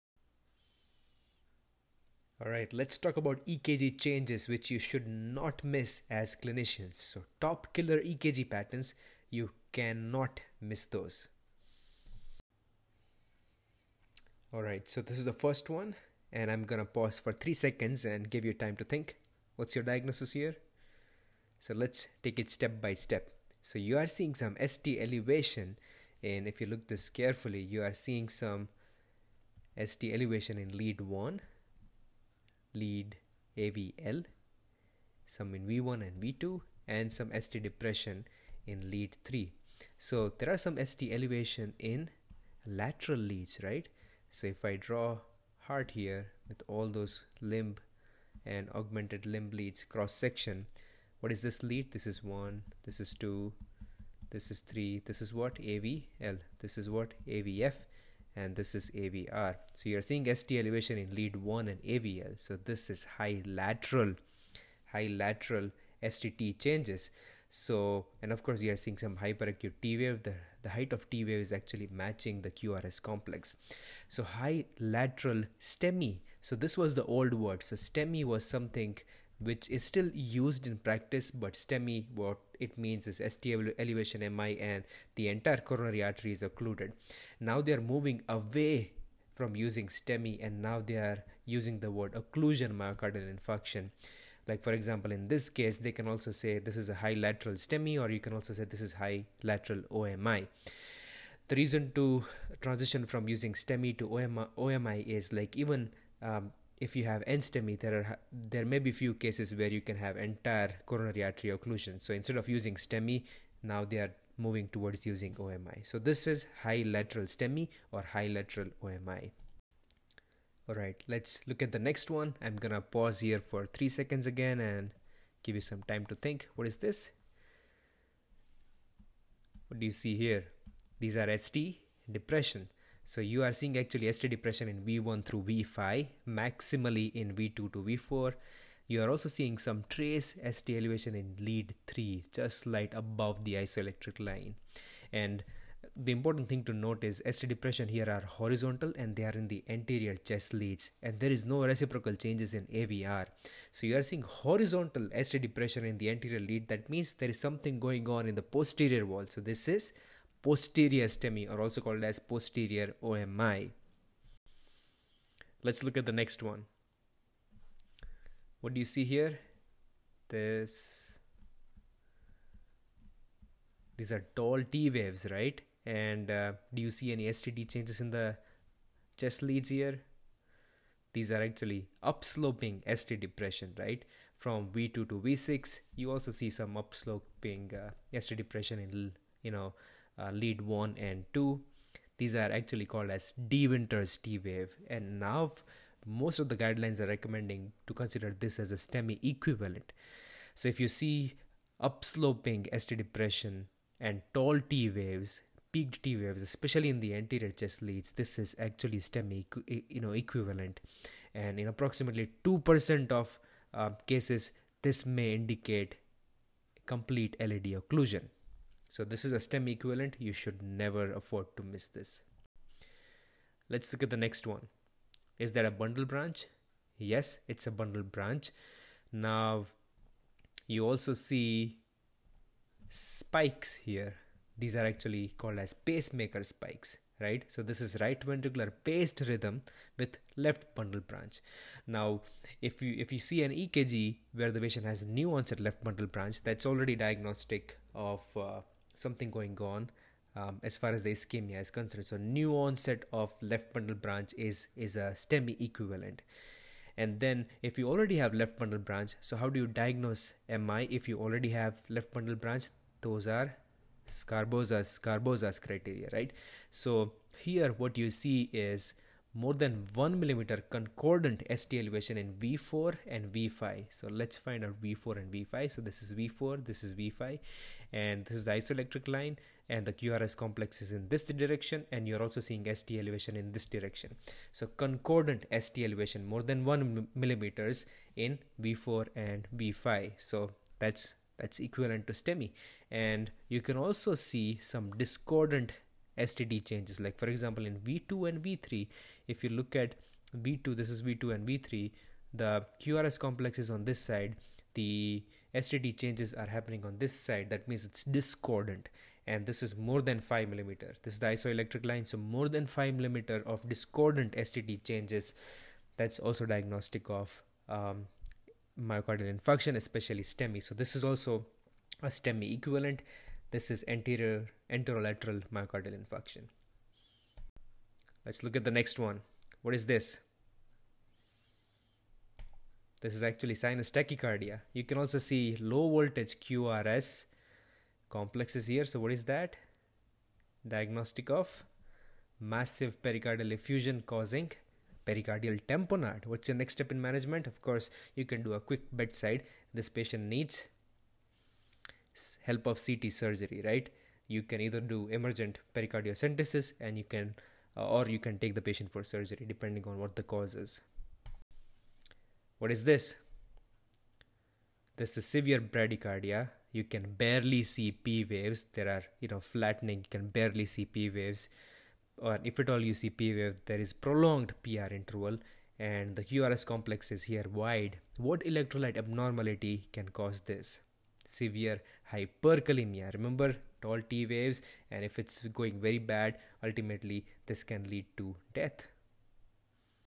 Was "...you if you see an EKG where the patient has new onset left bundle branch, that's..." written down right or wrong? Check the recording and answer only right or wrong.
right.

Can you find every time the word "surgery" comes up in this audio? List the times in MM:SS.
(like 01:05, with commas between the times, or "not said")
05:53, 05:59.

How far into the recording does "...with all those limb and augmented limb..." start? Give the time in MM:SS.
00:46.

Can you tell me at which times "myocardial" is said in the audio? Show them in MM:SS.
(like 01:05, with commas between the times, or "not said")
01:32, 05:18, 05:25.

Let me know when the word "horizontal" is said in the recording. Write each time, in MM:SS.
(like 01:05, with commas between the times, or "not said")
02:28, 02:34.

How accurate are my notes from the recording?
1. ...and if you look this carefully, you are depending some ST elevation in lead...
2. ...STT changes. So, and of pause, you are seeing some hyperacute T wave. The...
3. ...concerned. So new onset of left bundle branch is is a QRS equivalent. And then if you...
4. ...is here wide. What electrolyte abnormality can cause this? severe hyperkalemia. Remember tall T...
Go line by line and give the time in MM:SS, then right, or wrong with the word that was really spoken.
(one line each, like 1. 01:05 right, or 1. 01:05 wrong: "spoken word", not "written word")
1. 00:26 wrong: "seeing", not "depending"
2. 01:06 wrong: "course", not "pause"
3. 04:11 wrong: "STEMI", not "QRS"
4. 06:17 right.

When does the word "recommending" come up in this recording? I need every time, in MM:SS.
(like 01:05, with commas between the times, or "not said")
03:17.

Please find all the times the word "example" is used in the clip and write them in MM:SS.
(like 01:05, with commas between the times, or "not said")
01:34, 04:57.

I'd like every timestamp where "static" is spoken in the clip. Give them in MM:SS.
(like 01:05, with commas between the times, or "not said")
not said.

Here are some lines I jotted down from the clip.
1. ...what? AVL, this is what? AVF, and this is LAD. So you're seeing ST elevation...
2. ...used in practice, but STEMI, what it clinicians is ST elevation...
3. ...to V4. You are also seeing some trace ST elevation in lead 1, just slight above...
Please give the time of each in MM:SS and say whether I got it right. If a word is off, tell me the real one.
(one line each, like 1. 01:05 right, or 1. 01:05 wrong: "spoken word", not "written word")
1. 00:55 wrong: "AVR", not "LAD"
2. 01:20 wrong: "means", not "clinicians"
3. 02:17 wrong: "3", not "1".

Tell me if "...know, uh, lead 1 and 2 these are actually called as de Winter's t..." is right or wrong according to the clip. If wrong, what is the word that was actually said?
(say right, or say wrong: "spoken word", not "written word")
right.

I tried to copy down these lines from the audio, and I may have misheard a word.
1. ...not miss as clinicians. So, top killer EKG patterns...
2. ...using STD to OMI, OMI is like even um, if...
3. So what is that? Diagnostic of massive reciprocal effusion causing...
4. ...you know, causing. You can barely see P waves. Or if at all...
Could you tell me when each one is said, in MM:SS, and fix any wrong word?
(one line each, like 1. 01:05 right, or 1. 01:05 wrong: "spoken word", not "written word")
1. 00:05 right
2. 01:43 wrong: "STEMI", not "STD"
3. 05:38 wrong: "pericardial", not "reciprocal"
4. 06:09 wrong: "flattening", not "causing".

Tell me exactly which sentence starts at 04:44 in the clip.
So concordant ST elevation more than 1 millimeters in V4 and V5.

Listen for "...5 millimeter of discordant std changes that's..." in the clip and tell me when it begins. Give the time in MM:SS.
05:12.